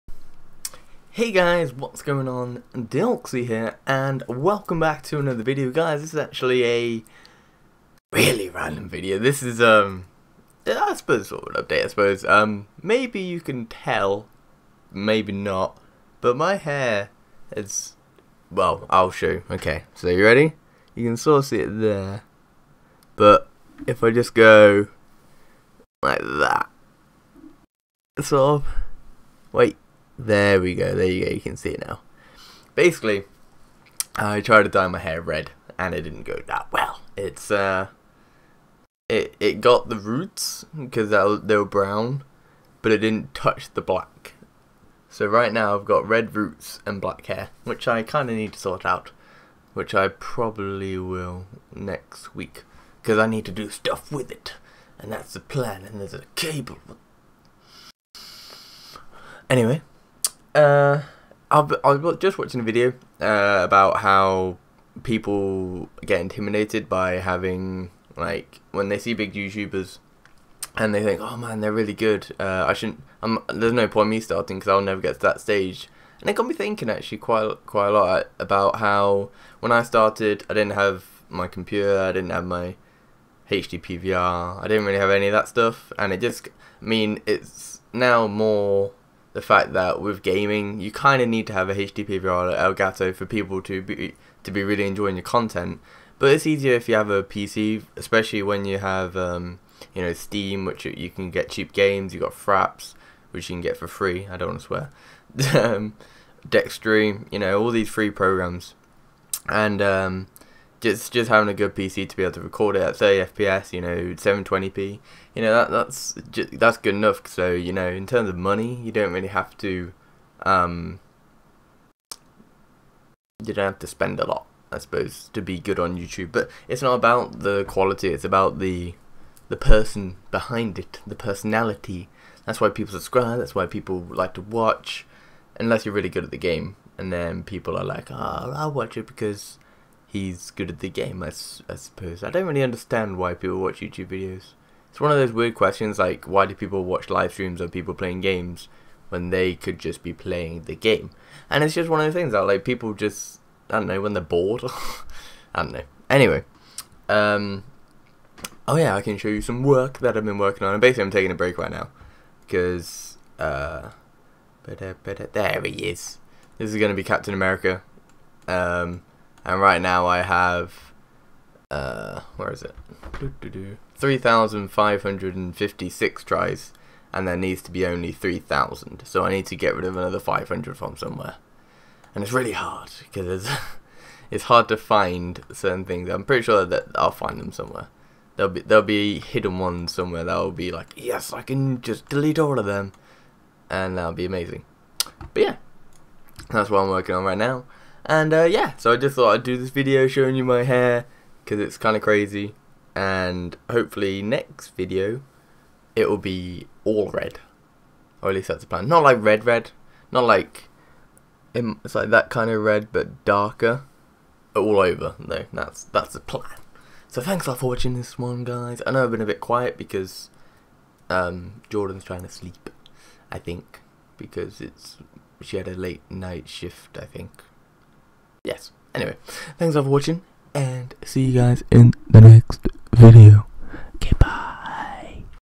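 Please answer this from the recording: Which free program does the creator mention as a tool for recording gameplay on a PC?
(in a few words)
Fraps.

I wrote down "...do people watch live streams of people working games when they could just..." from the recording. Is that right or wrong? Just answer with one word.
wrong.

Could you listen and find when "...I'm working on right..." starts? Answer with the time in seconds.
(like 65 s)
196 s.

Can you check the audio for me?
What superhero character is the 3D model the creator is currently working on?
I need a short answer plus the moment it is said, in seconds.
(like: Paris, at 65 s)
Captain America, at 167 s.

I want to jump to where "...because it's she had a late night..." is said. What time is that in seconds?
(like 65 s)
224 s.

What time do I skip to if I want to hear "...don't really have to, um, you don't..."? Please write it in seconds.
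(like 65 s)
118 s.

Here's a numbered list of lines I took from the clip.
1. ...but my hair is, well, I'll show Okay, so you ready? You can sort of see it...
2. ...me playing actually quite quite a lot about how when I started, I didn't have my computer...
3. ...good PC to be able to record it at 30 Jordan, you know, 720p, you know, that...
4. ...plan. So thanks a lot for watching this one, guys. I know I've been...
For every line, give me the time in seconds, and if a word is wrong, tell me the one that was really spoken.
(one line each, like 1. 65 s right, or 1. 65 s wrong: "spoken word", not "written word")
1. 16 s right
2. 76 s wrong: "thinking", not "playing"
3. 111 s wrong: "FPS", not "Jordan"
4. 216 s right.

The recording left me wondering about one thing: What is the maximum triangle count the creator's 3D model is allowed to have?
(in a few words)
3,000.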